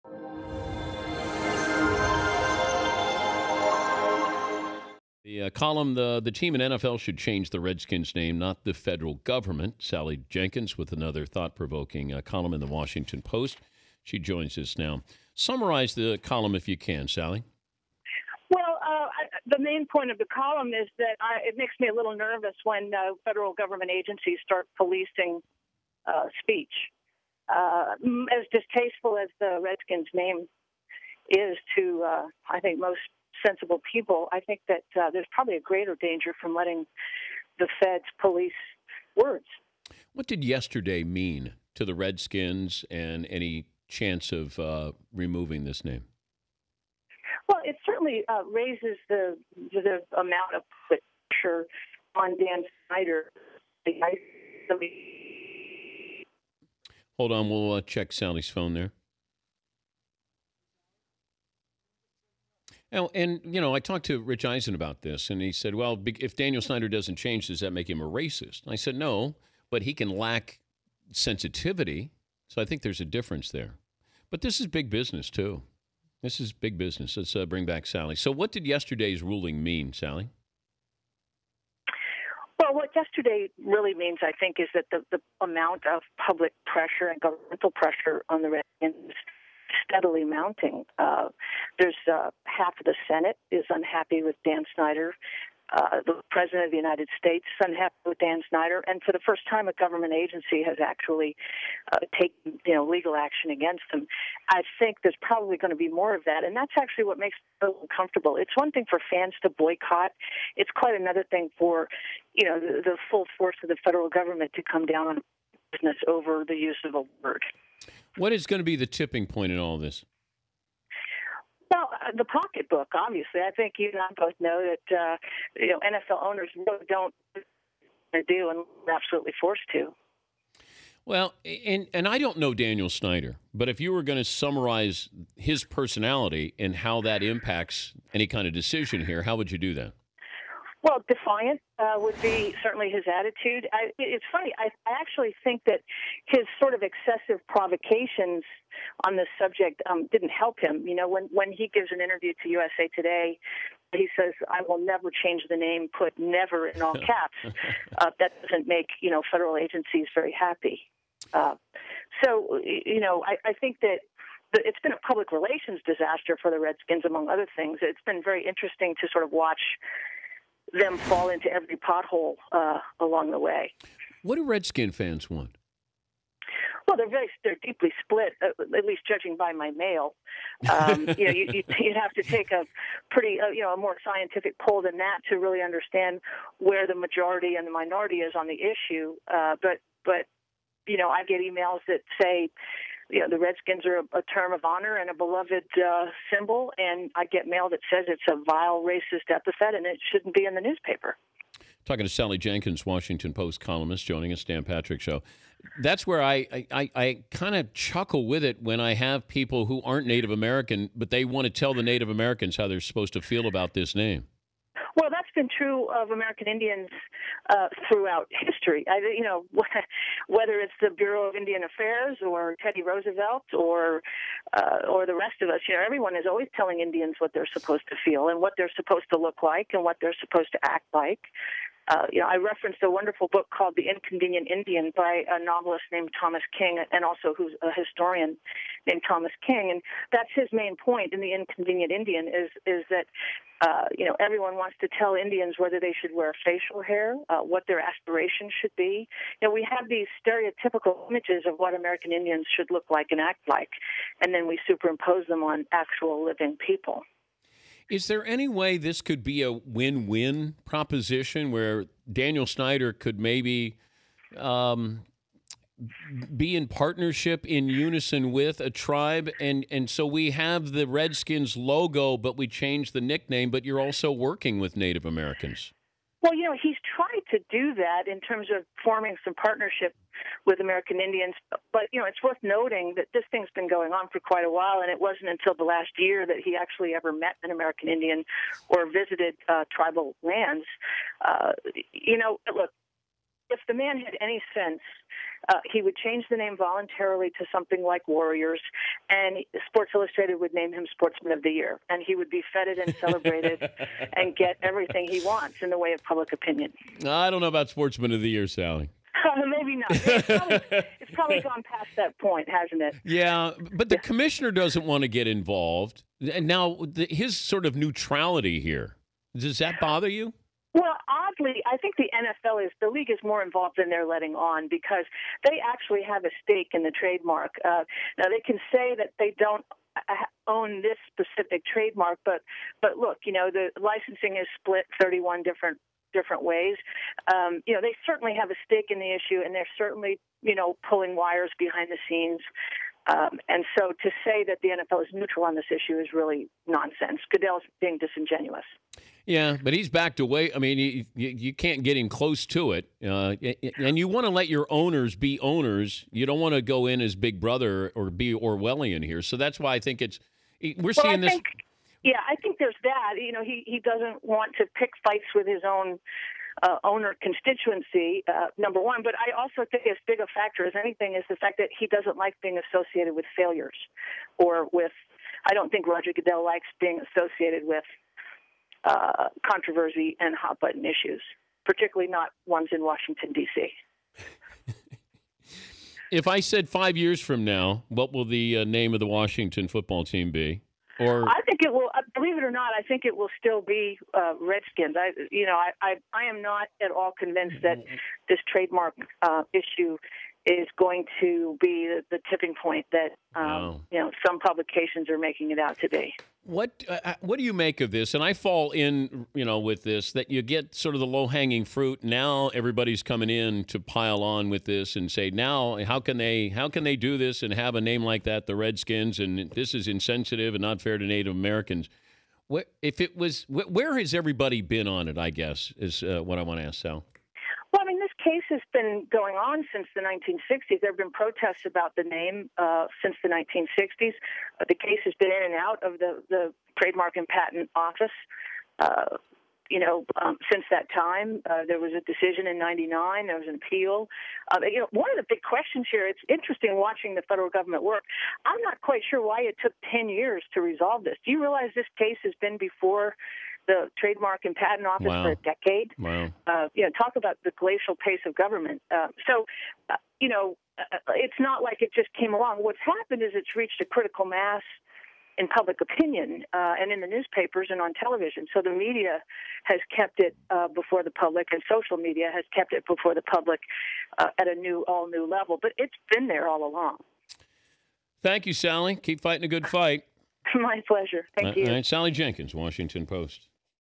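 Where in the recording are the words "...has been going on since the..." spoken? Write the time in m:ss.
7:08.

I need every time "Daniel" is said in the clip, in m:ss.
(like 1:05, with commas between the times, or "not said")
1:06, 2:12, 4:22.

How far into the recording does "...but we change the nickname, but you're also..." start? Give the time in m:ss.
4:32.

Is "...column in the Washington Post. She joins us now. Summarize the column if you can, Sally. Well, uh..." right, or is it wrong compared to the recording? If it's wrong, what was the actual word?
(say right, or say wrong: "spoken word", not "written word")
right.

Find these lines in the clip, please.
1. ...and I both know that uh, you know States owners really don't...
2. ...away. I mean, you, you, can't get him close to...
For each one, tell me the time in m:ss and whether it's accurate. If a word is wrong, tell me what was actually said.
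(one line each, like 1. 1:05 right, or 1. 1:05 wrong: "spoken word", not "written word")
1. 2:03 wrong: "NFL", not "States"
2. 5:50 right.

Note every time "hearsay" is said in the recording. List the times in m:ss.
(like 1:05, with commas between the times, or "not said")
not said.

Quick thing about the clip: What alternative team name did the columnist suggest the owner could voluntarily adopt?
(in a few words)
Warriors.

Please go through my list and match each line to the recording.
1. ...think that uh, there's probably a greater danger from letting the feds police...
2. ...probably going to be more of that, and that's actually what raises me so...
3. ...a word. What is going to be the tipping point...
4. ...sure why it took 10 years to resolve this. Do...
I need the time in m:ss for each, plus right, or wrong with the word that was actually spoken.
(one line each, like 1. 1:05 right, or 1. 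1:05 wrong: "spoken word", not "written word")
1. 0:34 right
2. 1:45 wrong: "makes", not "raises"
3. 1:56 right
4. 7:29 right.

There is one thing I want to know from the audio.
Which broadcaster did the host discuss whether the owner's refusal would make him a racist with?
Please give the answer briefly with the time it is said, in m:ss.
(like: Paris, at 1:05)
Rich Eisen, at 1:04.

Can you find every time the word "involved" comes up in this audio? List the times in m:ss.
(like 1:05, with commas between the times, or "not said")
5:15, 5:23.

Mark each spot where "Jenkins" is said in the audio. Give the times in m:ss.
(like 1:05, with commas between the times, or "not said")
0:10, 3:22, 8:02.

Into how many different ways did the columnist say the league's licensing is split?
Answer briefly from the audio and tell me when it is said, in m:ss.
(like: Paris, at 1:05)
31, at 5:34.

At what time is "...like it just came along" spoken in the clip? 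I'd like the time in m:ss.
7:41.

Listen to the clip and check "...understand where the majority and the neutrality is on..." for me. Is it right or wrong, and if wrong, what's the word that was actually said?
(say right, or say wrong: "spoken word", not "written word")
wrong: "minority", not "neutrality".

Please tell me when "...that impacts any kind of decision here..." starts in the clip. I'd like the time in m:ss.
2:17.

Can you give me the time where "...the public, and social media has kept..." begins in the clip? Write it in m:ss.
7:51.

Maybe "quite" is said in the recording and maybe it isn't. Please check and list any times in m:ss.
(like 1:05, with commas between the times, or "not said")
1:50, 4:44, 7:28.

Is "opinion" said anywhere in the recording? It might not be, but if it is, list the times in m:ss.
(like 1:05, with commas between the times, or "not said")
5:06, 7:45.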